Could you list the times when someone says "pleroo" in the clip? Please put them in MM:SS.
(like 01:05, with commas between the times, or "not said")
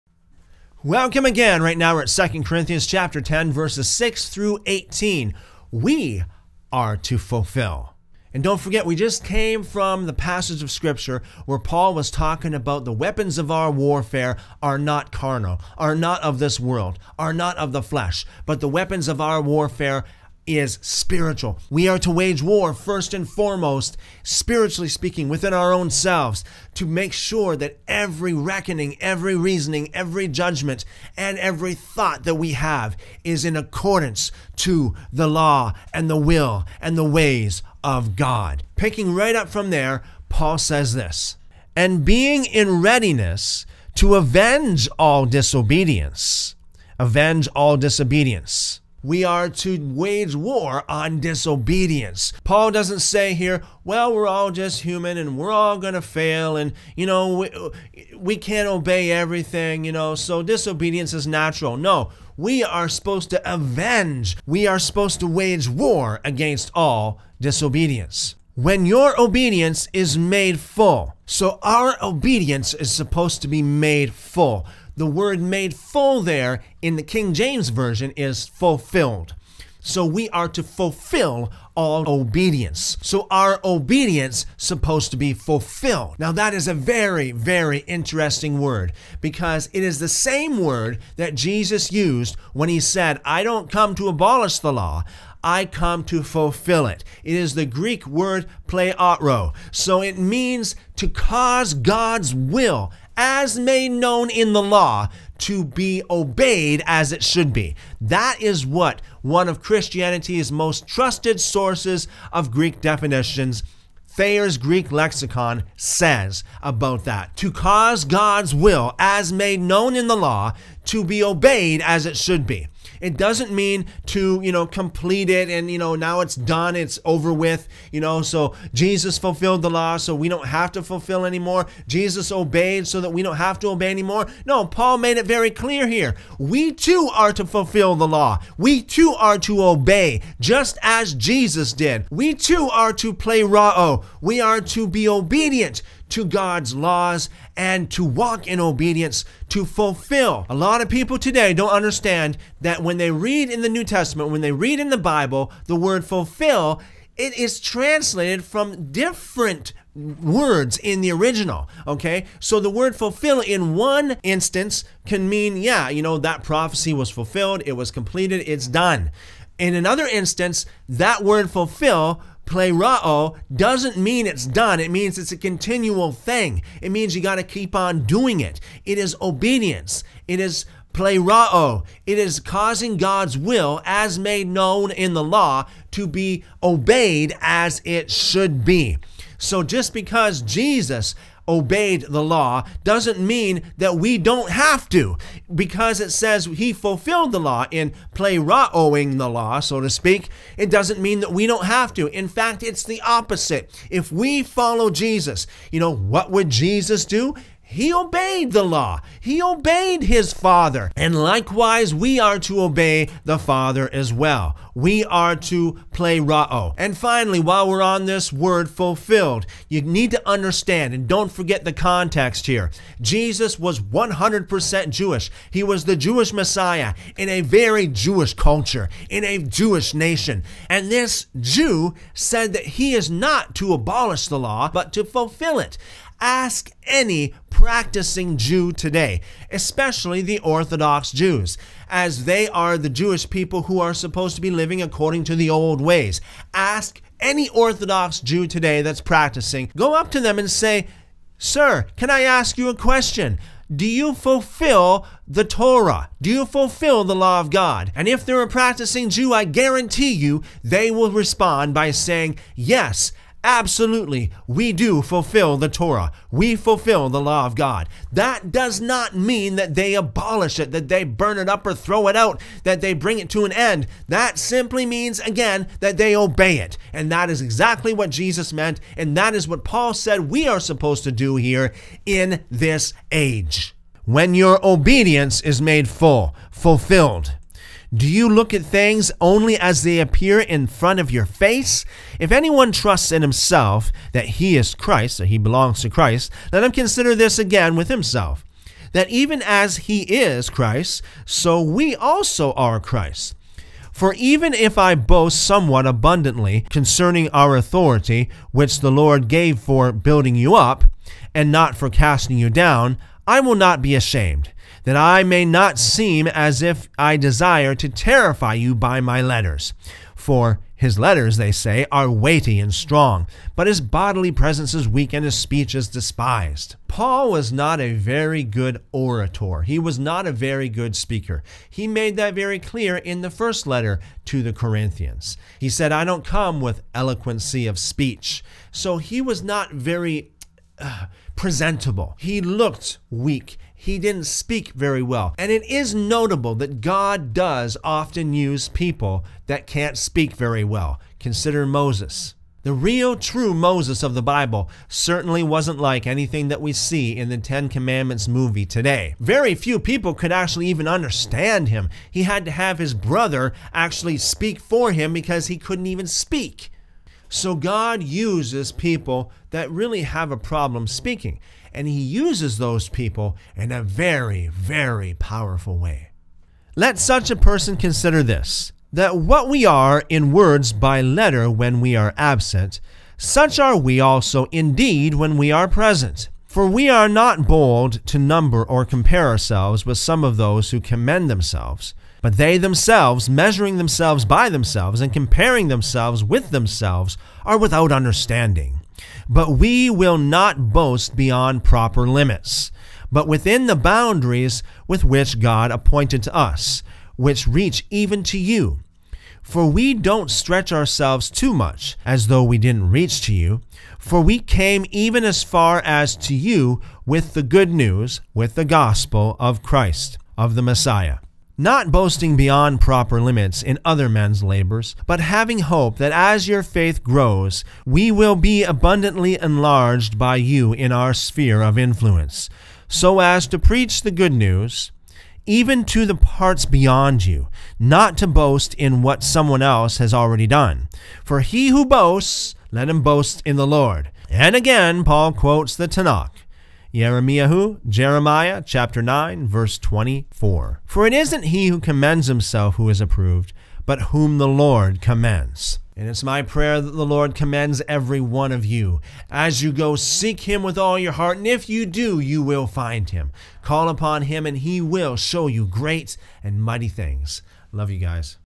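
01:38, 02:23, 03:35.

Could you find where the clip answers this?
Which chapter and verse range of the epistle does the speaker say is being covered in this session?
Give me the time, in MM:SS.
00:03.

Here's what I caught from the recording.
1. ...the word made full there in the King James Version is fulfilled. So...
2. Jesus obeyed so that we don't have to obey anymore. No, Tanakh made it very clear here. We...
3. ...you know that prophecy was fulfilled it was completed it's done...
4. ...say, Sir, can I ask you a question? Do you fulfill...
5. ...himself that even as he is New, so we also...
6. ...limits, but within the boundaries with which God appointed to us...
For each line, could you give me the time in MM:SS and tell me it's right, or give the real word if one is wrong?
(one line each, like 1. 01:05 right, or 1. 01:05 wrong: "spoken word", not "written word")
1. 01:14 right
2. 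02:11 wrong: "Paul", not "Tanakh"
3. 02:45 right
4. 04:10 right
5. 04:57 wrong: "Christ", not "New"
6. 06:42 right.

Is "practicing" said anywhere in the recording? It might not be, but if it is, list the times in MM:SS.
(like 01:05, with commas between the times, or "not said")
03:57, 04:09, 04:18.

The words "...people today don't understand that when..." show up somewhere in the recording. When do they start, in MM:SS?
02:30.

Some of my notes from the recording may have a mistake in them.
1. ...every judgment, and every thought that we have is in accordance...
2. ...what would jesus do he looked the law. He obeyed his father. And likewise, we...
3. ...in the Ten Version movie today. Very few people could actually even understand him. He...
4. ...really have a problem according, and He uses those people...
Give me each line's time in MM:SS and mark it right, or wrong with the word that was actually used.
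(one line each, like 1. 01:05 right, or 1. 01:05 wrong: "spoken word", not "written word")
1. 00:29 right
2. 03:25 wrong: "obeyed", not "looked"
3. 05:57 wrong: "Commandments", not "Version"
4. 06:09 wrong: "speaking", not "according".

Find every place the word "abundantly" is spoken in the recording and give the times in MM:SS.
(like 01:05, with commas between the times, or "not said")
05:05, 07:08.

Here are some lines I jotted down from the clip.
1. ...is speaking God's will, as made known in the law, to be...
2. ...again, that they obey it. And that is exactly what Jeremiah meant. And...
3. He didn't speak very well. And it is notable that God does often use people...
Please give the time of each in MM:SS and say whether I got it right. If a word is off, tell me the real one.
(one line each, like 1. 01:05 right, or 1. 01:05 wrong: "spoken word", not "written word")
1. 03:02 wrong: "causing", not "speaking"
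2. 04:35 wrong: "Jesus", not "Jeremiah"
3. 05:43 right.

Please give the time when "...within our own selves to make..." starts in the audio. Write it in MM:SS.
00:25.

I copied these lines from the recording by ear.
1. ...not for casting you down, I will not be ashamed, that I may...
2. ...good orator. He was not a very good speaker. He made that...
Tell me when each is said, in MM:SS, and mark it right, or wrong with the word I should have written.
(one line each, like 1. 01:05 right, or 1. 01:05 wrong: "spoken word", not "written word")
1. 05:11 right
2. 05:28 right.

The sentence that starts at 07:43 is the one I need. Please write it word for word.
Call upon him, and he will show you great and mighty things.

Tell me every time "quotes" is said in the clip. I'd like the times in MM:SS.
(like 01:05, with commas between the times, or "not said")
07:25.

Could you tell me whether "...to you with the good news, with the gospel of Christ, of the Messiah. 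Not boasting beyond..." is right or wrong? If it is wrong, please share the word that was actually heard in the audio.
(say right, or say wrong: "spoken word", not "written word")
right.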